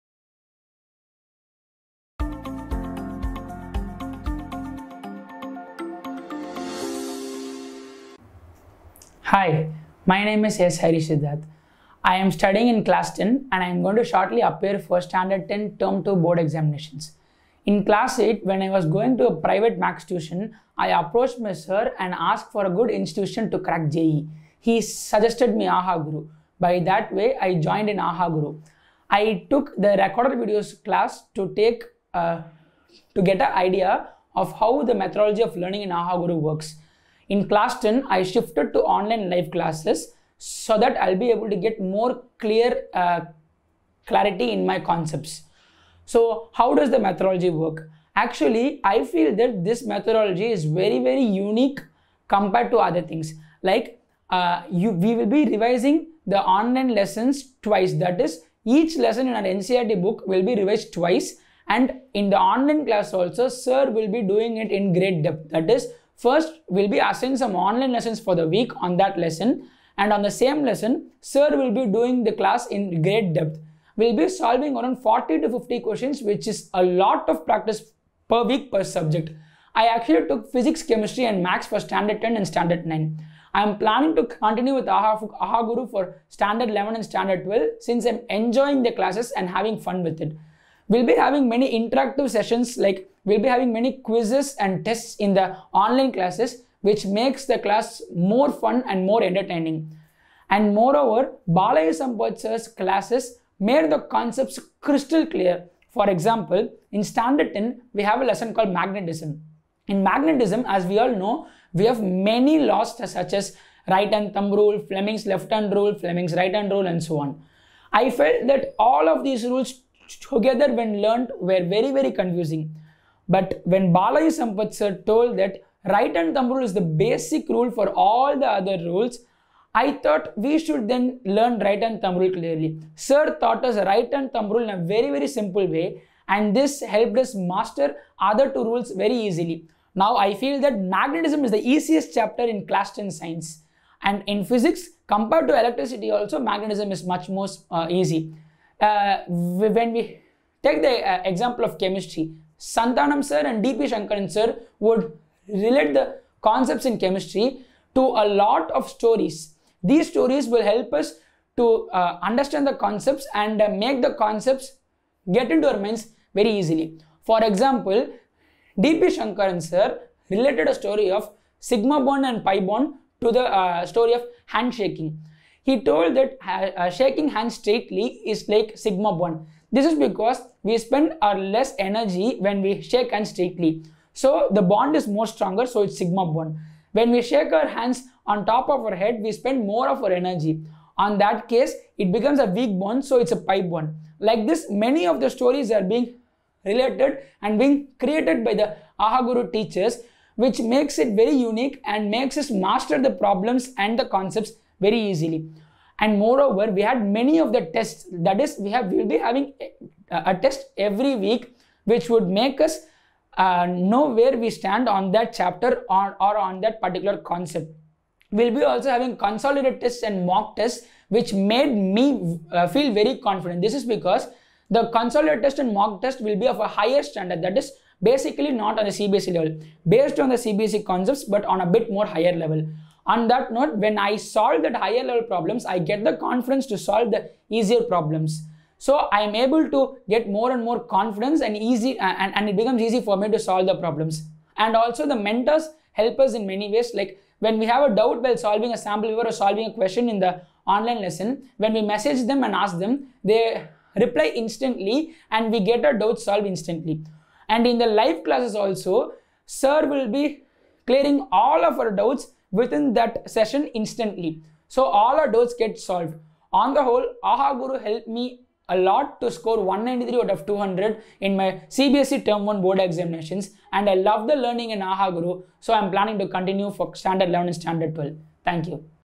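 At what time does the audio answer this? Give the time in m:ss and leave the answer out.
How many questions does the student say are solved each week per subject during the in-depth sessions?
1:15.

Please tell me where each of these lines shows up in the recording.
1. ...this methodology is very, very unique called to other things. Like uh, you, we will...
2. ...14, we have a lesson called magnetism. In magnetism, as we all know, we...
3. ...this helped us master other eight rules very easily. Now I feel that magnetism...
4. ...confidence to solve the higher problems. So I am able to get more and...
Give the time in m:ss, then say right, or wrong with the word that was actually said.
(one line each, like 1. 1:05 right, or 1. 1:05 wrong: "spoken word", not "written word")
1. 0:49 wrong: "compared", not "called"
2. 1:47 wrong: "10", not "14"
3. 2:16 wrong: "two", not "eight"
4. 3:56 wrong: "easier", not "higher".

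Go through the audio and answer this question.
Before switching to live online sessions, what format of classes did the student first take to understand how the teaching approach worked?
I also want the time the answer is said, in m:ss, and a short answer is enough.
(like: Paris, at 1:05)
Recorded videos, at 0:29.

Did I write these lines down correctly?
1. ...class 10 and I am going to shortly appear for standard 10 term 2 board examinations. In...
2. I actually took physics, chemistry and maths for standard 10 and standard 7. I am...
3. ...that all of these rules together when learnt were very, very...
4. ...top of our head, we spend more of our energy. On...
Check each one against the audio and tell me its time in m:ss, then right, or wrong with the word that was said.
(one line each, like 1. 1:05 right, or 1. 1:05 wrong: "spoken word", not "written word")
1. 0:12 right
2. 1:19 wrong: "9", not "7"
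3. 1:58 right
4. 3:08 right.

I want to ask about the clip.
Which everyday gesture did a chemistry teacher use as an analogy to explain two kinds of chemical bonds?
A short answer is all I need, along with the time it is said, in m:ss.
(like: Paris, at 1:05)
Handshaking, at 2:54.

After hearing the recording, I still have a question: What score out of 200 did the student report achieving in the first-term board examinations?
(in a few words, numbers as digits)
193.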